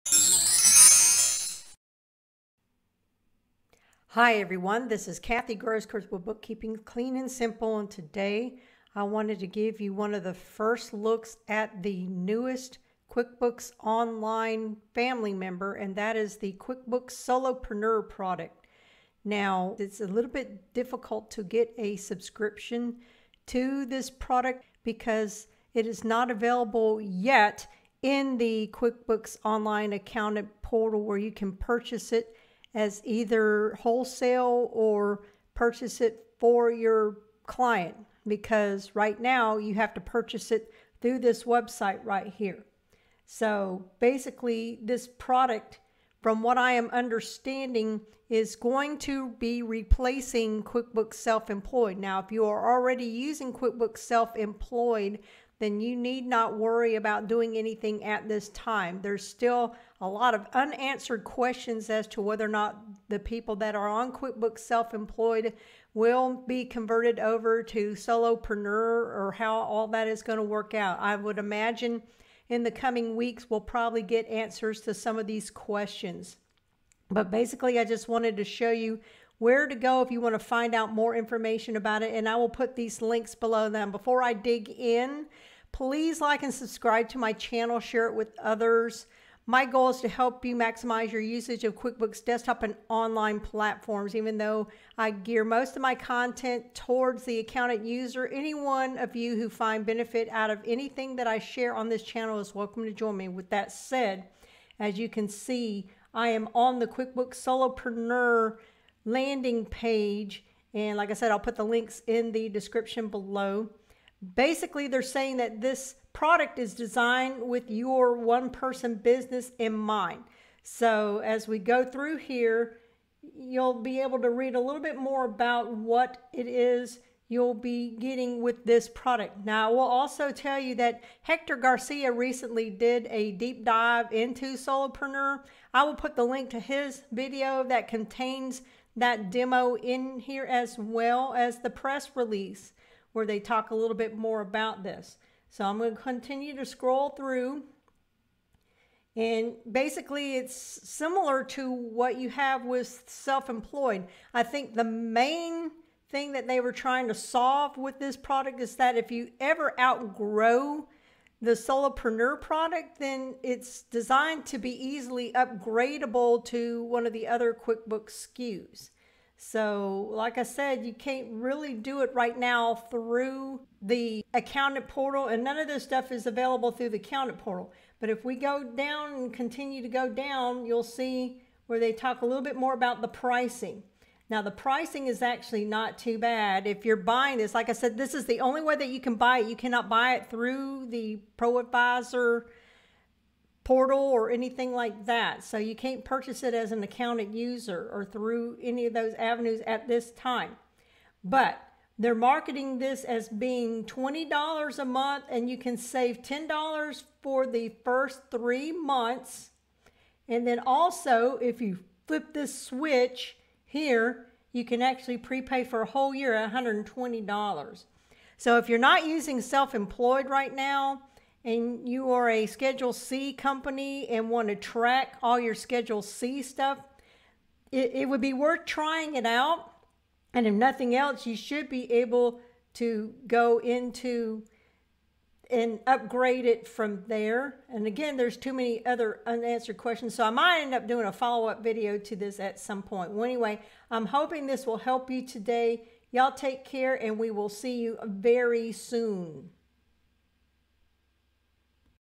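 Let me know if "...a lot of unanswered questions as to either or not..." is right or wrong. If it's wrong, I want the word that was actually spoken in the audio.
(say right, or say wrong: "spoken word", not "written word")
wrong: "whether", not "either".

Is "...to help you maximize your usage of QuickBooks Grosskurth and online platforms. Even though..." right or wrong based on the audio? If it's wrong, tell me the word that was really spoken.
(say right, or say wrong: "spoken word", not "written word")
wrong: "Desktop", not "Grosskurth".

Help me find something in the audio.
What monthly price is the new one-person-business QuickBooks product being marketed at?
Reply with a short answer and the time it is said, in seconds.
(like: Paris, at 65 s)
$20 a month, at 203 s.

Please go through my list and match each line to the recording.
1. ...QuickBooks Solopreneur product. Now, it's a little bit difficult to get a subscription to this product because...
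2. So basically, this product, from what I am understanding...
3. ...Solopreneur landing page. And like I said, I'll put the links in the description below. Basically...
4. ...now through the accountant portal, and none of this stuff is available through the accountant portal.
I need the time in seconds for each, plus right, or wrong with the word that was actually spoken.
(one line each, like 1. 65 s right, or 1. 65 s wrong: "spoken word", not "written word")
1. 16 s right
2. 43 s right
3. 107 s right
4. 172 s right.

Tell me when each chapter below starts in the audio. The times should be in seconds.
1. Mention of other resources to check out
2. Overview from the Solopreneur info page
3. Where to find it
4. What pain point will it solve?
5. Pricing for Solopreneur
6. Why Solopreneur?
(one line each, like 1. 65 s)
1. 129 s
2. 105 s
3. 19 s
4. 153 s
5. 177 s
6. 43 s.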